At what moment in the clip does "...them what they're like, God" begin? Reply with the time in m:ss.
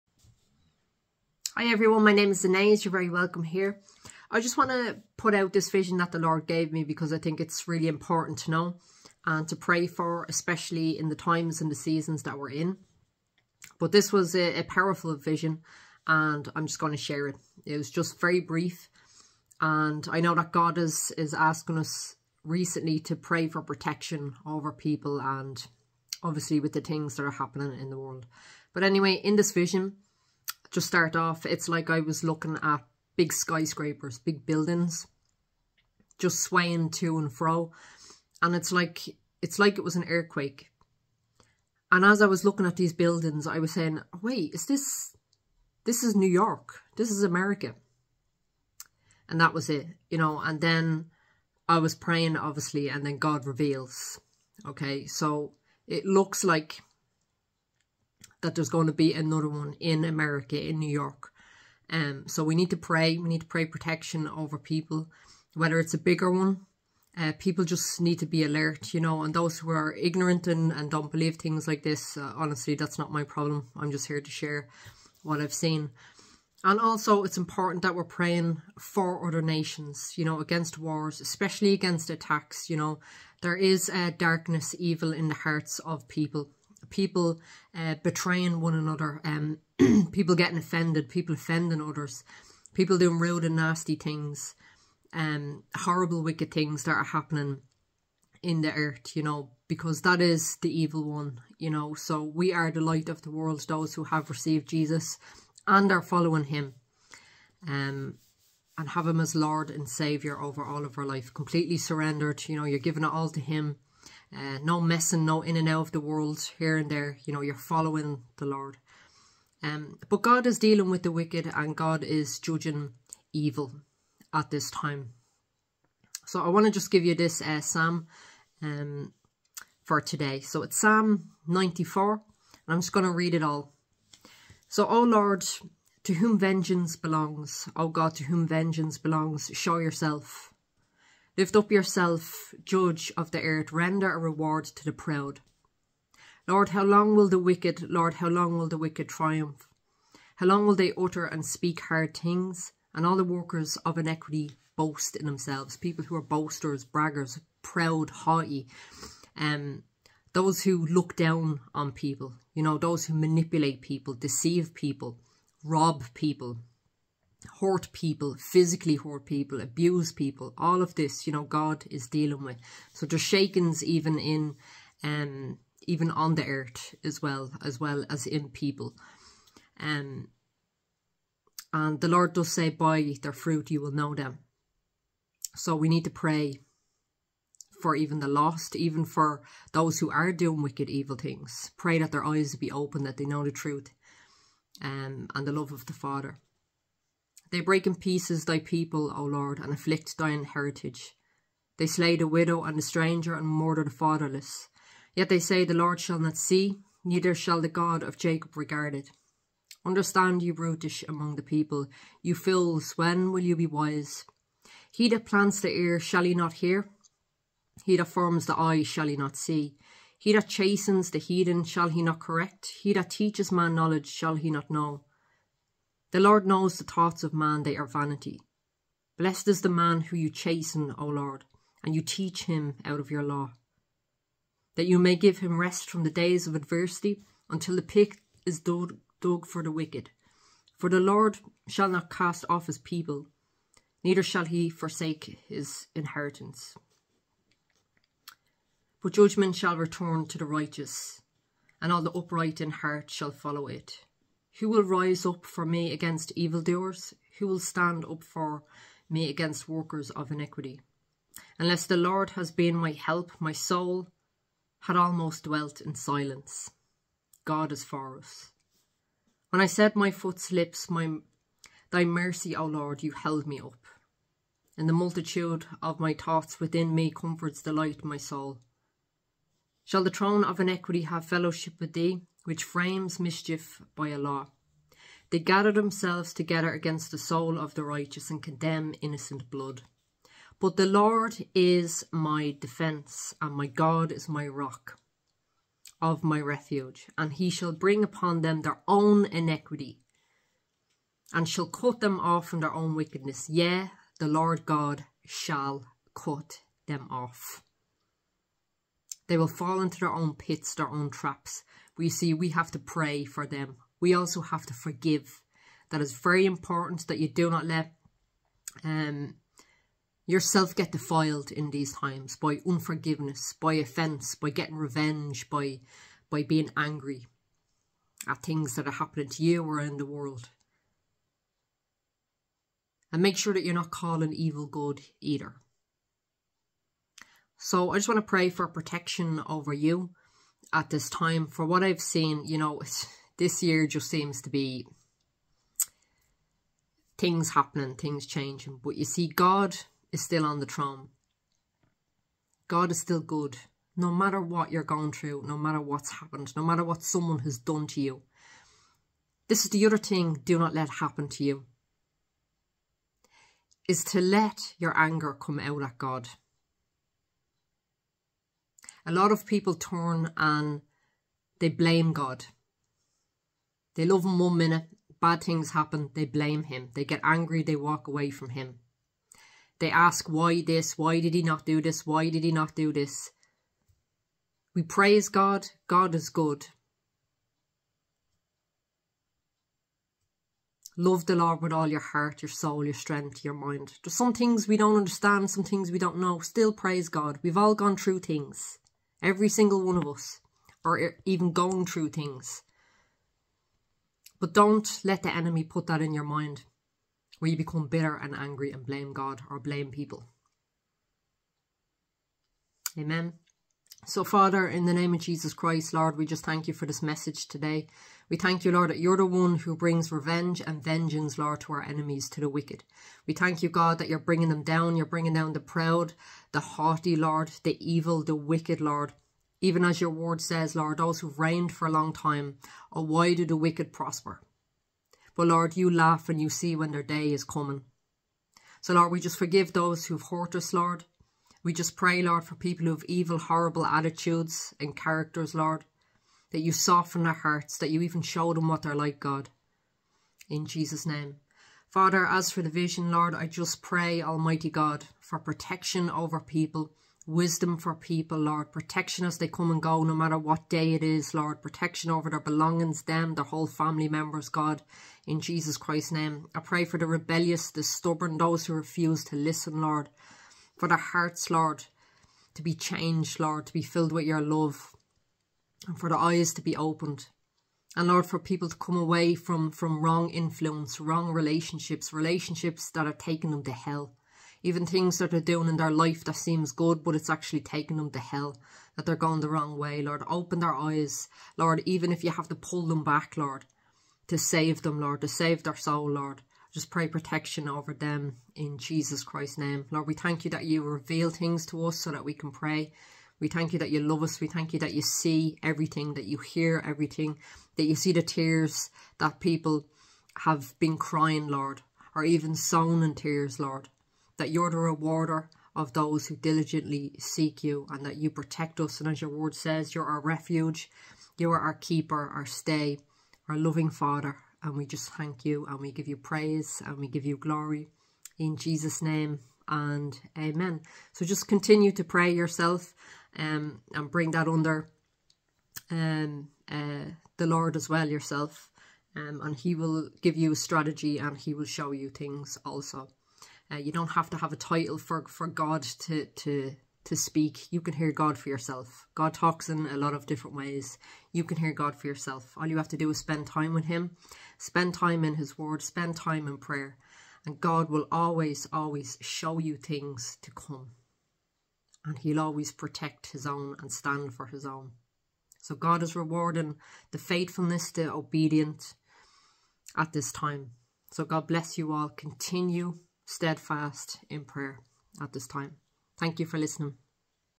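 7:28.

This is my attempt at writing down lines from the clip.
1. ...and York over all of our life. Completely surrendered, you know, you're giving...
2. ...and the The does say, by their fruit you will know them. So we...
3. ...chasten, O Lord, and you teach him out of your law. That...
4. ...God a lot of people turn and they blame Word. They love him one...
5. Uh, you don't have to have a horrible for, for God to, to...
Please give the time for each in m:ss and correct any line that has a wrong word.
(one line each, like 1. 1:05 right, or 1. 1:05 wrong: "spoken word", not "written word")
1. 1:49 wrong: "Saviour", not "York"
2. 3:01 wrong: "Lord", not "The"
3. 3:50 right
4. 6:05 wrong: "God", not "Word"
5. 9:03 wrong: "title", not "horrible".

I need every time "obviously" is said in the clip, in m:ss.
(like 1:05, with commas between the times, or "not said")
0:26, 0:52.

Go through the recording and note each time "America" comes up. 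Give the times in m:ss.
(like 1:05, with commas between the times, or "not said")
0:47, 1:00.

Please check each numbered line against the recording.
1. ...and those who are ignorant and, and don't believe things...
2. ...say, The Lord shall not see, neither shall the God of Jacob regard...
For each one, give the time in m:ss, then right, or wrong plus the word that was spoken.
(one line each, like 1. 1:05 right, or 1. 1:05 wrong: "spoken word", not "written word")
1. 1:09 right
2. 3:25 right.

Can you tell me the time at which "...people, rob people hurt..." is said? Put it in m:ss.
2:44.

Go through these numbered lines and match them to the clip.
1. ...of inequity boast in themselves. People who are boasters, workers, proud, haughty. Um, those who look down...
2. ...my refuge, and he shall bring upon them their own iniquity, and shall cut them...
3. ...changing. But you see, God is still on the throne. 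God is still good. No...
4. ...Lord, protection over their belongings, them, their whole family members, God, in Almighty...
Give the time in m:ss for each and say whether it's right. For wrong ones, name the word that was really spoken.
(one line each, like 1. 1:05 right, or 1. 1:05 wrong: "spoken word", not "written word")
1. 2:33 wrong: "braggers", not "workers"
2. 4:56 right
3. 5:48 right
4. 7:41 wrong: "Jesus", not "Almighty".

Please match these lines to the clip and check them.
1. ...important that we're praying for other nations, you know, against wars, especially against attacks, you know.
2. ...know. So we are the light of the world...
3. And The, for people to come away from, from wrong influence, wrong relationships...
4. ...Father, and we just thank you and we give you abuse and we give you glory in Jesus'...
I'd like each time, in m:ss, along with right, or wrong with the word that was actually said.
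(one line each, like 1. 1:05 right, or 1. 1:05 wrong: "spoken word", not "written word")
1. 1:17 right
2. 1:41 right
3. 7:57 wrong: "Lord", not "The"
4. 8:43 wrong: "praise", not "abuse".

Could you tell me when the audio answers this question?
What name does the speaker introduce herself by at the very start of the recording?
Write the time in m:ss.
0:02.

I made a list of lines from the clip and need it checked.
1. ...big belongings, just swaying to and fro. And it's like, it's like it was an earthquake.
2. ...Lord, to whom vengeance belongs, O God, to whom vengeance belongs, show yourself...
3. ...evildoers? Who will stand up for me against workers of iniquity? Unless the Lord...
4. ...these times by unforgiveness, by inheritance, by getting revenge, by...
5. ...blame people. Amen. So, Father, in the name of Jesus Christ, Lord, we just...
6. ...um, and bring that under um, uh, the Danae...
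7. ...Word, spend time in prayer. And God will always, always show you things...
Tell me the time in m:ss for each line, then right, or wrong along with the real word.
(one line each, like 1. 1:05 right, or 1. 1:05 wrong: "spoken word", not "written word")
1. 0:34 wrong: "buildings", not "belongings"
2. 2:15 right
3. 4:16 right
4. 5:21 wrong: "offence", not "inheritance"
5. 6:49 right
6. 8:53 wrong: "Lord", not "Danae"
7. 9:15 right.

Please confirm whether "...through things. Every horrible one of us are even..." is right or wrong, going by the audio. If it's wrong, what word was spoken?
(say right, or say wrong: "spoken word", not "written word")
wrong: "single", not "horrible".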